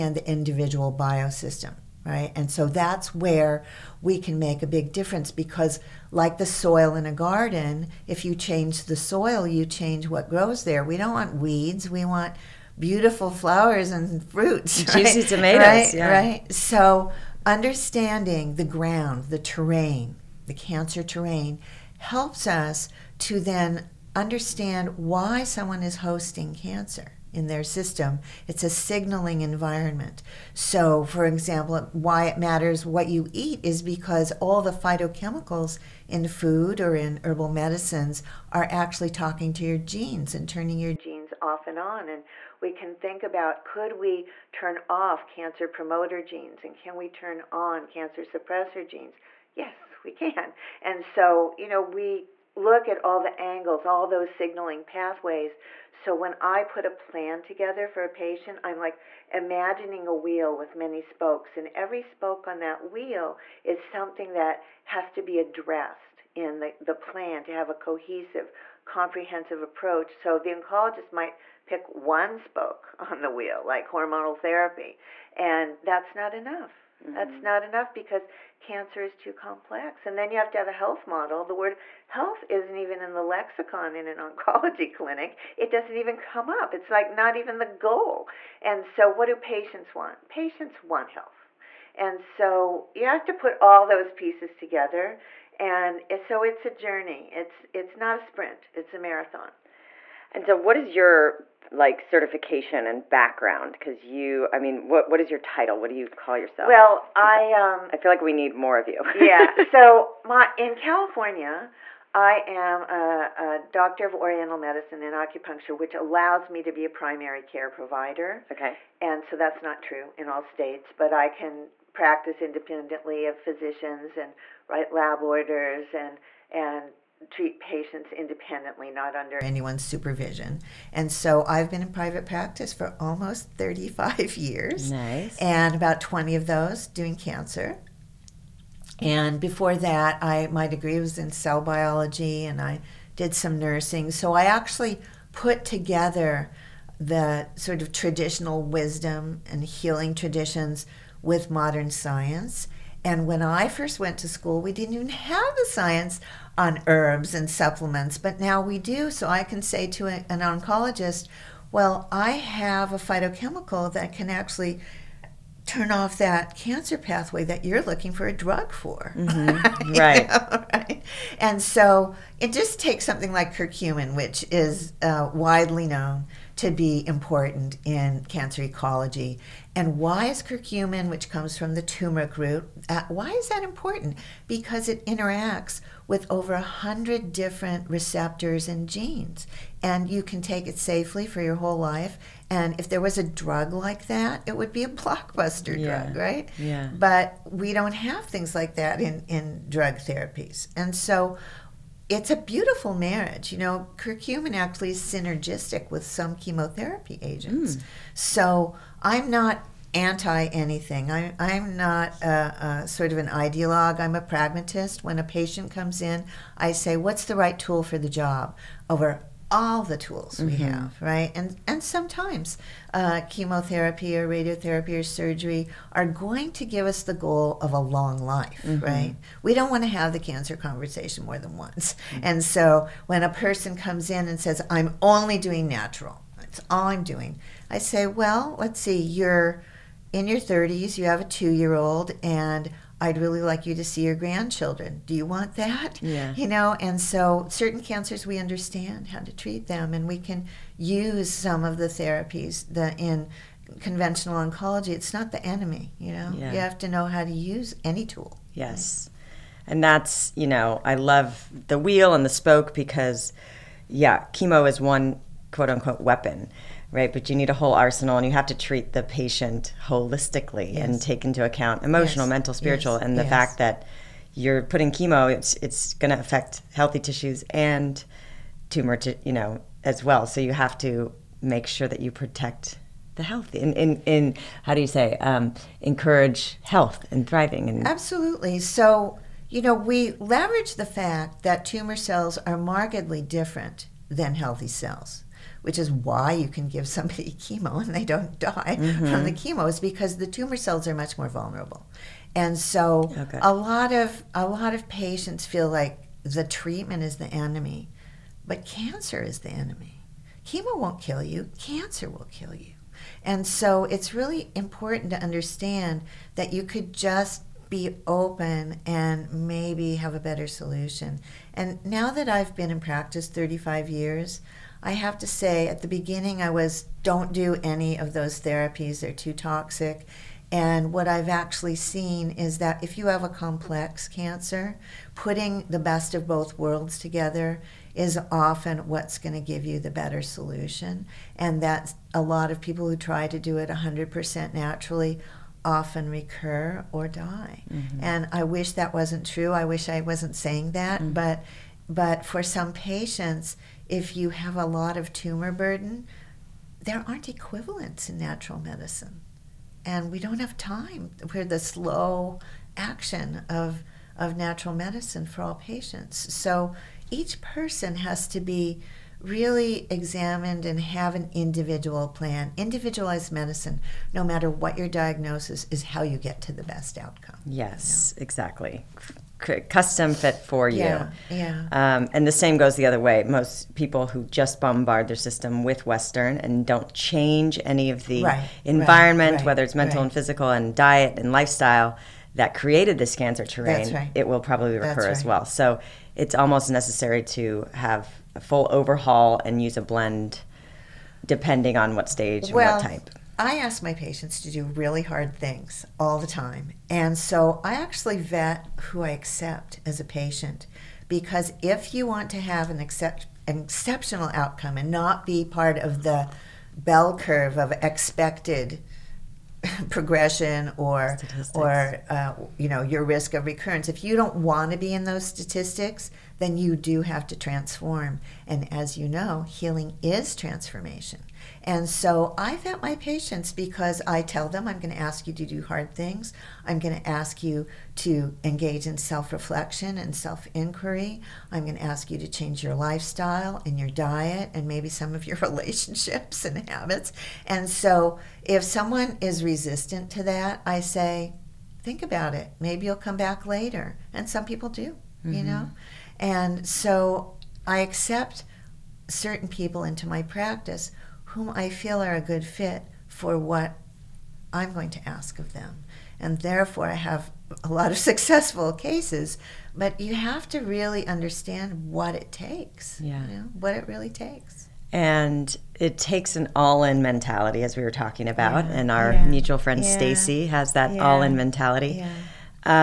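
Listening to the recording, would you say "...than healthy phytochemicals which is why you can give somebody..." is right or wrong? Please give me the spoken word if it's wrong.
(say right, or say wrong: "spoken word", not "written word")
wrong: "cells", not "phytochemicals".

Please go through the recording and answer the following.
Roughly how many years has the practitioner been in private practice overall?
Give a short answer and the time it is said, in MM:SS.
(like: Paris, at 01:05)
35, at 02:12.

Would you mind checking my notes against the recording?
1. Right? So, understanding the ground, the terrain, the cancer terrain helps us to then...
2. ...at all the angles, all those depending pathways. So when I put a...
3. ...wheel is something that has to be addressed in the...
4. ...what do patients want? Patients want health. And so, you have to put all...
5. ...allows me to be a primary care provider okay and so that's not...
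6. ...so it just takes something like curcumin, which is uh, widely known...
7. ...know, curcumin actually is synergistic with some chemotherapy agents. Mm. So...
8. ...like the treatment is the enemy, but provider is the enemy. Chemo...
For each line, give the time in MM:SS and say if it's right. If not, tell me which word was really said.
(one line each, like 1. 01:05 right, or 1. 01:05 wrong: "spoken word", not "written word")
1. 00:16 right
2. 00:52 wrong: "signaling", not "depending"
3. 01:02 right
4. 01:29 right
5. 01:55 right
6. 02:51 right
7. 03:23 right
8. 05:05 wrong: "cancer", not "provider".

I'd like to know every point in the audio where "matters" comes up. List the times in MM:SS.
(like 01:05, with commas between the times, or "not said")
00:32, 06:14.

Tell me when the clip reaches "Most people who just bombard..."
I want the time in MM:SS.
06:23.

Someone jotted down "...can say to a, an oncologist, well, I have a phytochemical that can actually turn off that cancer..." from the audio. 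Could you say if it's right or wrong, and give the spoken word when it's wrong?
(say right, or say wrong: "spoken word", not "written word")
right.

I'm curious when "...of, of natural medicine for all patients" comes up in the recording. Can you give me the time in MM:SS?
06:03.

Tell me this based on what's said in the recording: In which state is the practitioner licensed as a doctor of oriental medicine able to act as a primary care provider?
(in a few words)
California.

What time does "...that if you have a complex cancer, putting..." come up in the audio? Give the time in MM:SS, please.
05:32.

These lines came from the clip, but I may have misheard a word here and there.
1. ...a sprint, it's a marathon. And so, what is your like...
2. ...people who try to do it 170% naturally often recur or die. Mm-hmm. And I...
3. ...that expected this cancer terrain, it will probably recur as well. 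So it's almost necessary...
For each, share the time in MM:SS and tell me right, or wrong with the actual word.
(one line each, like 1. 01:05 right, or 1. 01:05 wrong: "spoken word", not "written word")
1. 01:38 right
2. 05:42 wrong: "100", not "170"
3. 06:32 wrong: "created", not "expected".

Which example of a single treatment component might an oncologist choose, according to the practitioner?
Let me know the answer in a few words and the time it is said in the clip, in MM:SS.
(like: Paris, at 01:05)
Hormonal therapy, at 01:13.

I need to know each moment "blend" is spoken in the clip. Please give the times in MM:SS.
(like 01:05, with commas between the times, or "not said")
06:39.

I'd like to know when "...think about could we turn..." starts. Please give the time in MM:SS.
00:42.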